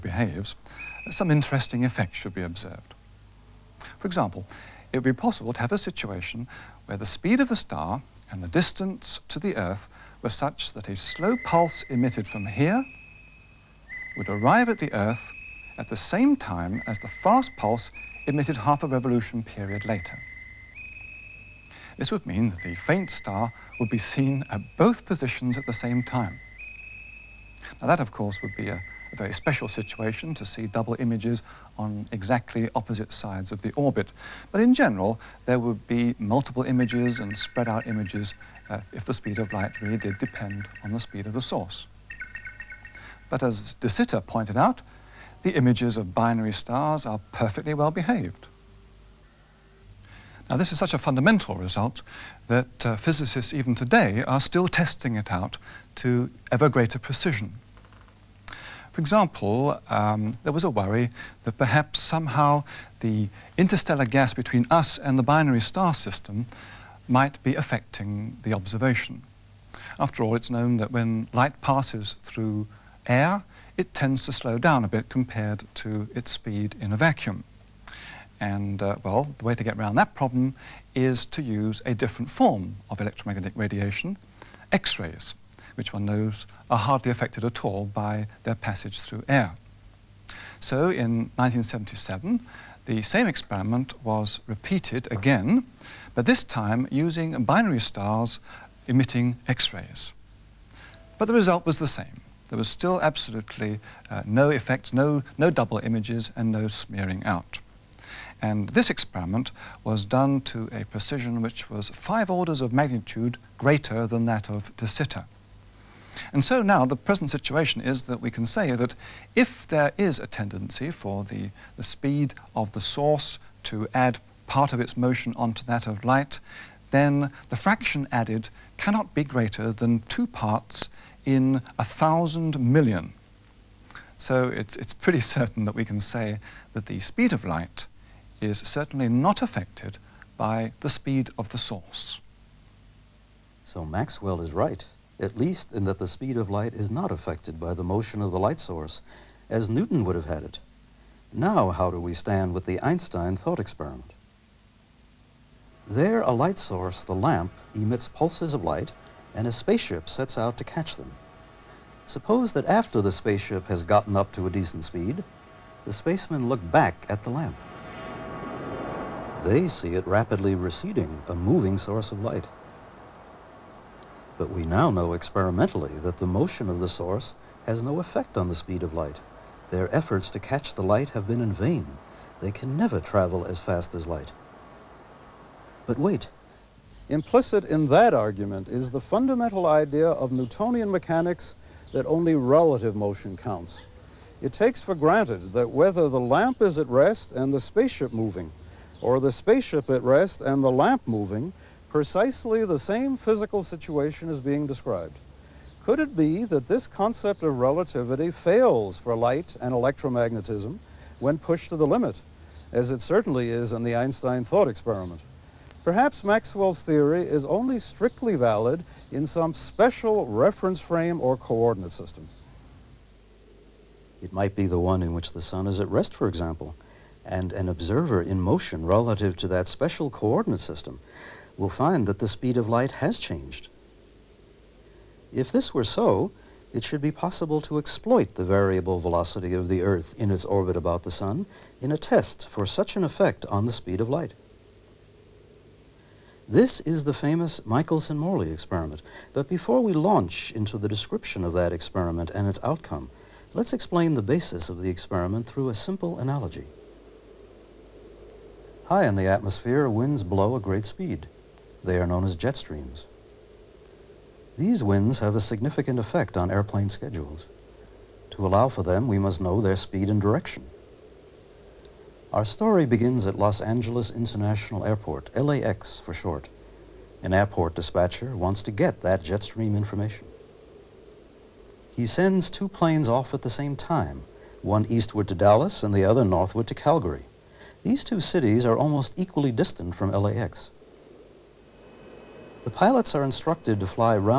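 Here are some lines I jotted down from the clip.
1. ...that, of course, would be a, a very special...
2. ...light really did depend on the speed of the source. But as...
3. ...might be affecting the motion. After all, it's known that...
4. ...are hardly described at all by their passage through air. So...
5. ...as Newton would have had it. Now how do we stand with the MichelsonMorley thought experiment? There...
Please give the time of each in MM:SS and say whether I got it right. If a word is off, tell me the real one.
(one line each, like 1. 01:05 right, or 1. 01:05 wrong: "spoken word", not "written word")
1. 00:27 right
2. 00:39 right
3. 01:07 wrong: "observation", not "motion"
4. 01:26 wrong: "affected", not "described"
5. 02:29 wrong: "Einstein", not "MichelsonMorley".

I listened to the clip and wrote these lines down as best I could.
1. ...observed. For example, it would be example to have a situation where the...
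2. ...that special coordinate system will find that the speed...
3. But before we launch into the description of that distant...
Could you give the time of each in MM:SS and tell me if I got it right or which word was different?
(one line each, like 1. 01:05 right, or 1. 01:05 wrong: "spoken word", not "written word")
1. 00:02 wrong: "possible", not "example"
2. 03:49 right
3. 04:09 wrong: "experiment", not "distant".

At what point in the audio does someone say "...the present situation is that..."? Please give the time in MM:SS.
01:56.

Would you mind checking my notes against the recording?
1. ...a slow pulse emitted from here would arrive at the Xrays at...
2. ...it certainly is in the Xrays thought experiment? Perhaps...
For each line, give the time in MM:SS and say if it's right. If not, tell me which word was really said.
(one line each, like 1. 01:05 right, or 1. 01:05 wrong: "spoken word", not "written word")
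1. 00:10 wrong: "Earth", not "Xrays"
2. 03:32 wrong: "Einstein", not "Xrays".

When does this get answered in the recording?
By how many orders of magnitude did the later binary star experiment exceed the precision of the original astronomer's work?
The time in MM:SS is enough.
01:51.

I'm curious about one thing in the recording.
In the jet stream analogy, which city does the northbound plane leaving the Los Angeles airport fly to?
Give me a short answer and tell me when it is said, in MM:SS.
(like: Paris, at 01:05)
Calgary, at 04:46.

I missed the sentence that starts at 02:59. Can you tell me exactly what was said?
Their efforts to catch the light have been in vain.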